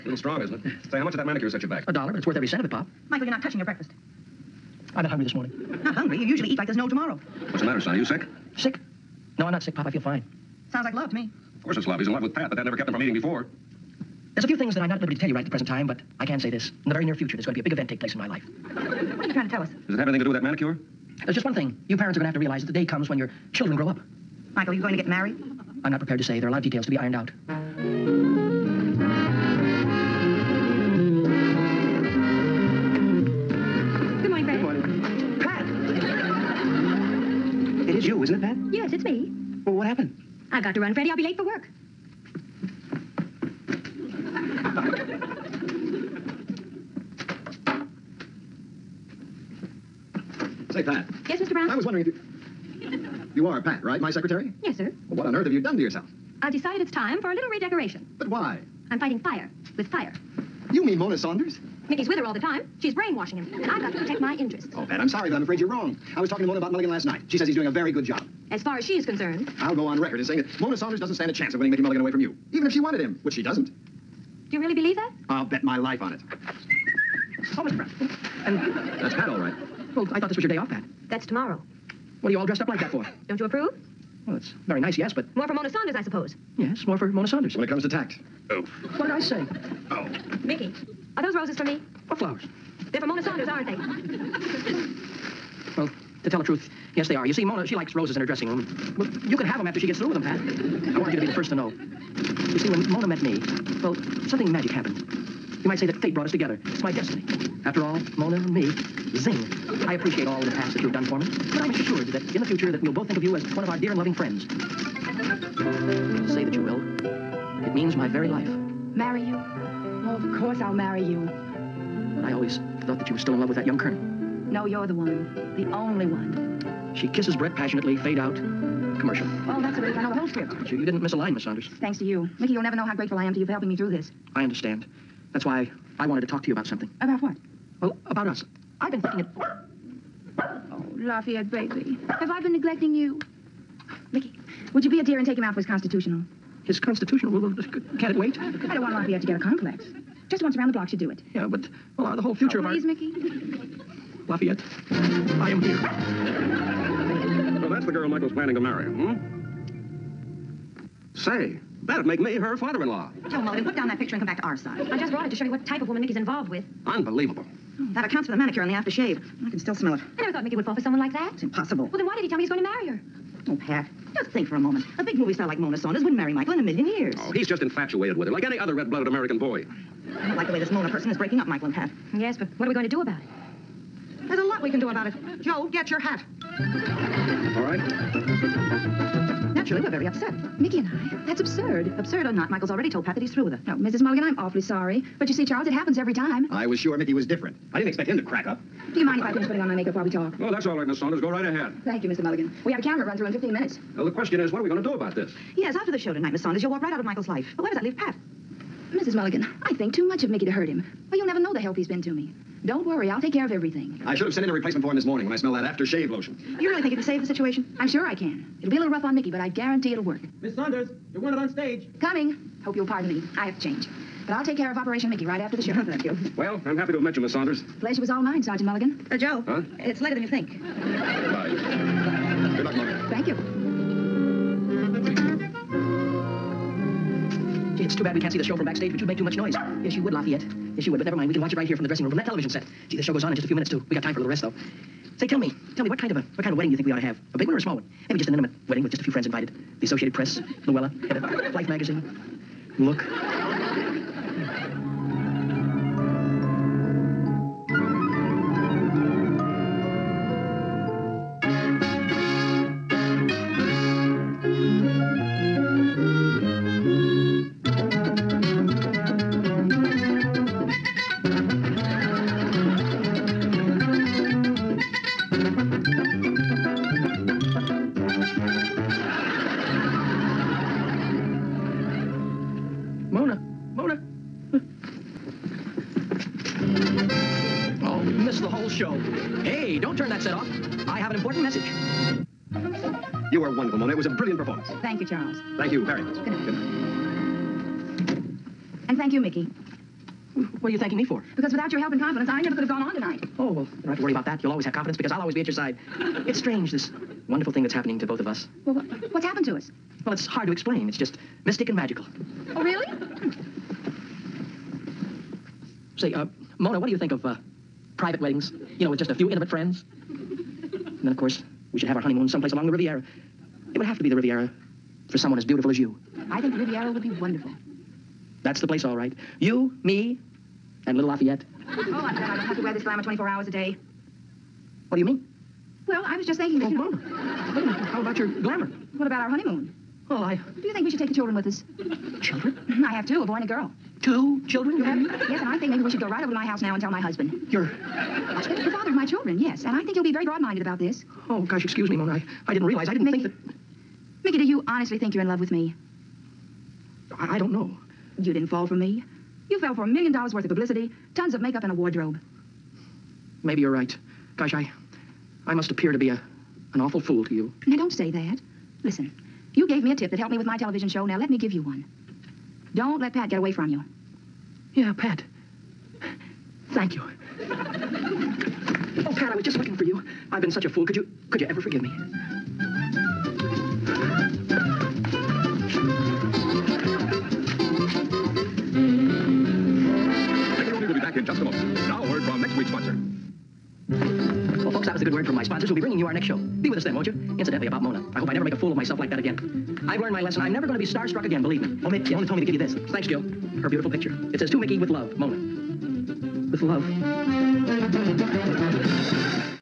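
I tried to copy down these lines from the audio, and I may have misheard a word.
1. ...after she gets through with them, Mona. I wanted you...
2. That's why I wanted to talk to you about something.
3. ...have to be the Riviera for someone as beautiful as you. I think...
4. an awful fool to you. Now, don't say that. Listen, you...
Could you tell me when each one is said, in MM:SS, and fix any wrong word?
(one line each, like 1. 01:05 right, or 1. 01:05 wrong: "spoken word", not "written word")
1. 01:39 wrong: "Pat", not "Mona"
2. 02:15 right
3. 05:23 right
4. 06:06 right.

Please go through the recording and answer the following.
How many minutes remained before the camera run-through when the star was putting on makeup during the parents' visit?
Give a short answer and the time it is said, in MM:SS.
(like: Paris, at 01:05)
15, at 03:23.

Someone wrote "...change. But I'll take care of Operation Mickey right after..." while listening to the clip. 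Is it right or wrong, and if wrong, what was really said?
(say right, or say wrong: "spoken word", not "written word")
right.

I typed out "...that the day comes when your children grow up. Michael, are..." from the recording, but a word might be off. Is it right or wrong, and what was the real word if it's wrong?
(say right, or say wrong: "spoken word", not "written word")
right.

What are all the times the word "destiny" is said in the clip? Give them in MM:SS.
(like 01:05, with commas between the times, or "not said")
01:46.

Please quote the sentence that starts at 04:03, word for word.
We got time for a little rest, though.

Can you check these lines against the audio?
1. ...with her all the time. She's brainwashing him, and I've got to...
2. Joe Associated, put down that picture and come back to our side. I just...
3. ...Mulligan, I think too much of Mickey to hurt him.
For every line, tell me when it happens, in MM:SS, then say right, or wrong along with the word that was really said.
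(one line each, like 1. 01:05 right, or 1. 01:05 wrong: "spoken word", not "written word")
1. 01:02 right
2. 02:43 wrong: "Mulligan", not "Associated"
3. 03:29 right.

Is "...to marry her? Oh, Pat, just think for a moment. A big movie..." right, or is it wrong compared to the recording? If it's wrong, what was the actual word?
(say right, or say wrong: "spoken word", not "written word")
right.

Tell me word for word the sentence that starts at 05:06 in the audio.
it's strange, this wonderful thing that's happening to both of us.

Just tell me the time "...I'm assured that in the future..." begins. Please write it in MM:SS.
01:51.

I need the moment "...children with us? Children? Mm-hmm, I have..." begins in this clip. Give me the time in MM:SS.
05:41.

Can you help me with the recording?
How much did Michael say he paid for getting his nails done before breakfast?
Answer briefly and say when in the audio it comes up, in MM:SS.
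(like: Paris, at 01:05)
A dollar, at 00:01.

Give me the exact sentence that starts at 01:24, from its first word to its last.
Well, it's very nice, yes, but.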